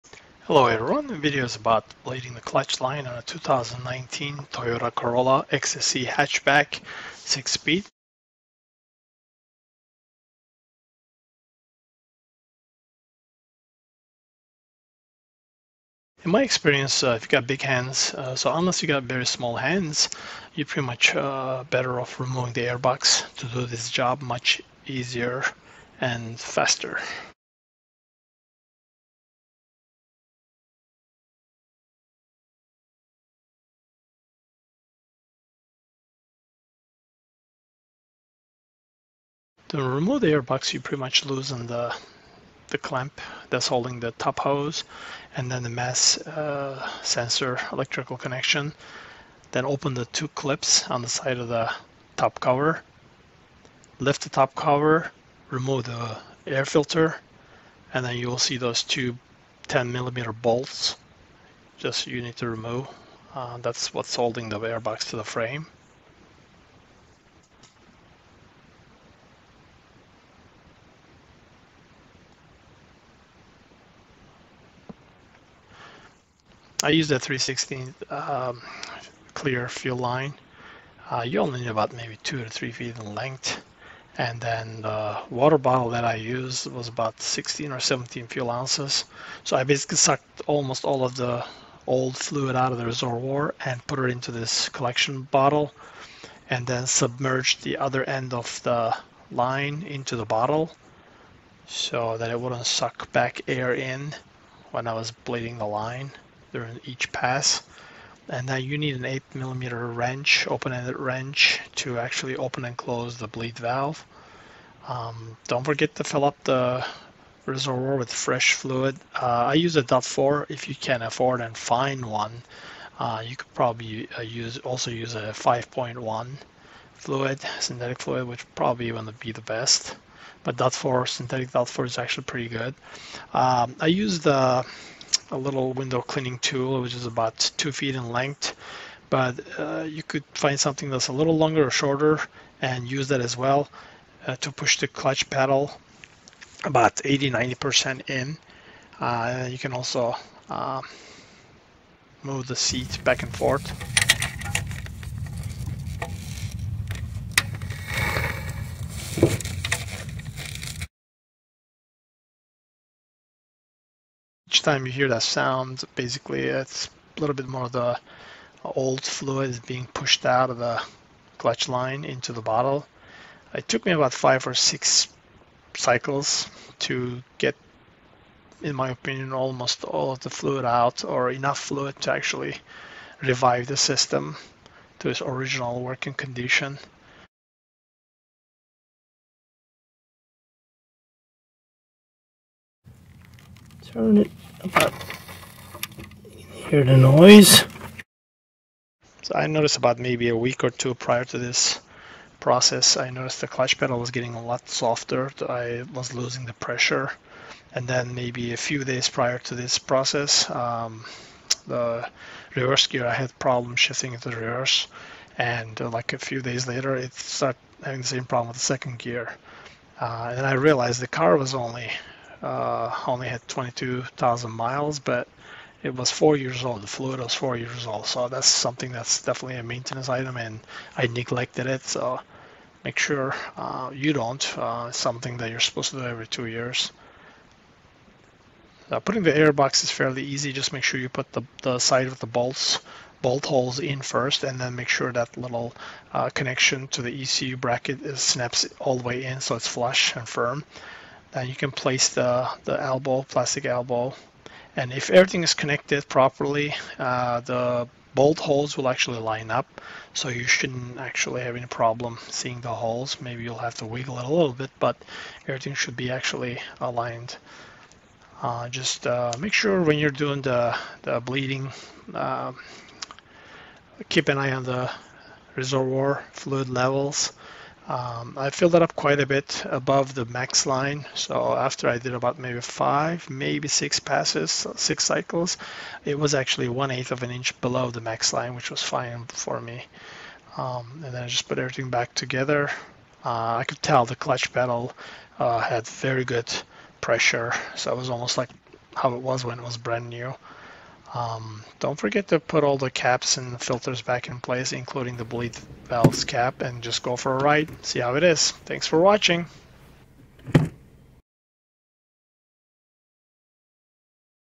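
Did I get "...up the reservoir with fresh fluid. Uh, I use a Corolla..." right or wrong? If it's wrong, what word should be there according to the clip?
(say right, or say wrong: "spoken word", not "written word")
wrong: "DOT", not "Corolla".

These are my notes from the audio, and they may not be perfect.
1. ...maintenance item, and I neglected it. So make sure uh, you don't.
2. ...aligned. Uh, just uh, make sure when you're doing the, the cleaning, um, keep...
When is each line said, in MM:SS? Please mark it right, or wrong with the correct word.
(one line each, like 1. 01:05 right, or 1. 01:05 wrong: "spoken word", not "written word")
1. 03:49 right
2. 04:26 wrong: "bleeding", not "cleaning".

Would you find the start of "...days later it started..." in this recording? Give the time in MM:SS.
03:36.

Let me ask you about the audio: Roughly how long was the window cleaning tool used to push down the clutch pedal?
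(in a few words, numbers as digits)
2 feet.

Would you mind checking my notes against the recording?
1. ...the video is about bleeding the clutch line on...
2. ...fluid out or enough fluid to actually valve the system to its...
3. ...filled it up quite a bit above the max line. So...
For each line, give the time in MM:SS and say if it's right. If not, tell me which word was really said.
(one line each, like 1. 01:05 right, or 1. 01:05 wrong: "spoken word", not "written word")
1. 00:01 right
2. 03:00 wrong: "revive", not "valve"
3. 04:38 right.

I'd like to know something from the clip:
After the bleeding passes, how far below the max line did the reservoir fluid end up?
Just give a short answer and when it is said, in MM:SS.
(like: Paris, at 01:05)
1/8 inch, at 04:46.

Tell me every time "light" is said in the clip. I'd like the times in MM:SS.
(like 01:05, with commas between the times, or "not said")
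not said.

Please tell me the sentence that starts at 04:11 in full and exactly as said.
Then uh, you can place the, the elbow, plastic elbow.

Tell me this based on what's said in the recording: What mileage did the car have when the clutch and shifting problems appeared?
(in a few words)
22,000 miles.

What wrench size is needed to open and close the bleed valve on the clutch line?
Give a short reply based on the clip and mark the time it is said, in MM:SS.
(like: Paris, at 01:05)
8 millimeter, at 01:49.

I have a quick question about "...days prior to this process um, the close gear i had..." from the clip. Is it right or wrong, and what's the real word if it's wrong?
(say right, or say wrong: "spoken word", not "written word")
wrong: "reverse", not "close".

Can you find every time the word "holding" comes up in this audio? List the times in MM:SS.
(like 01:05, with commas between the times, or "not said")
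00:43, 01:04.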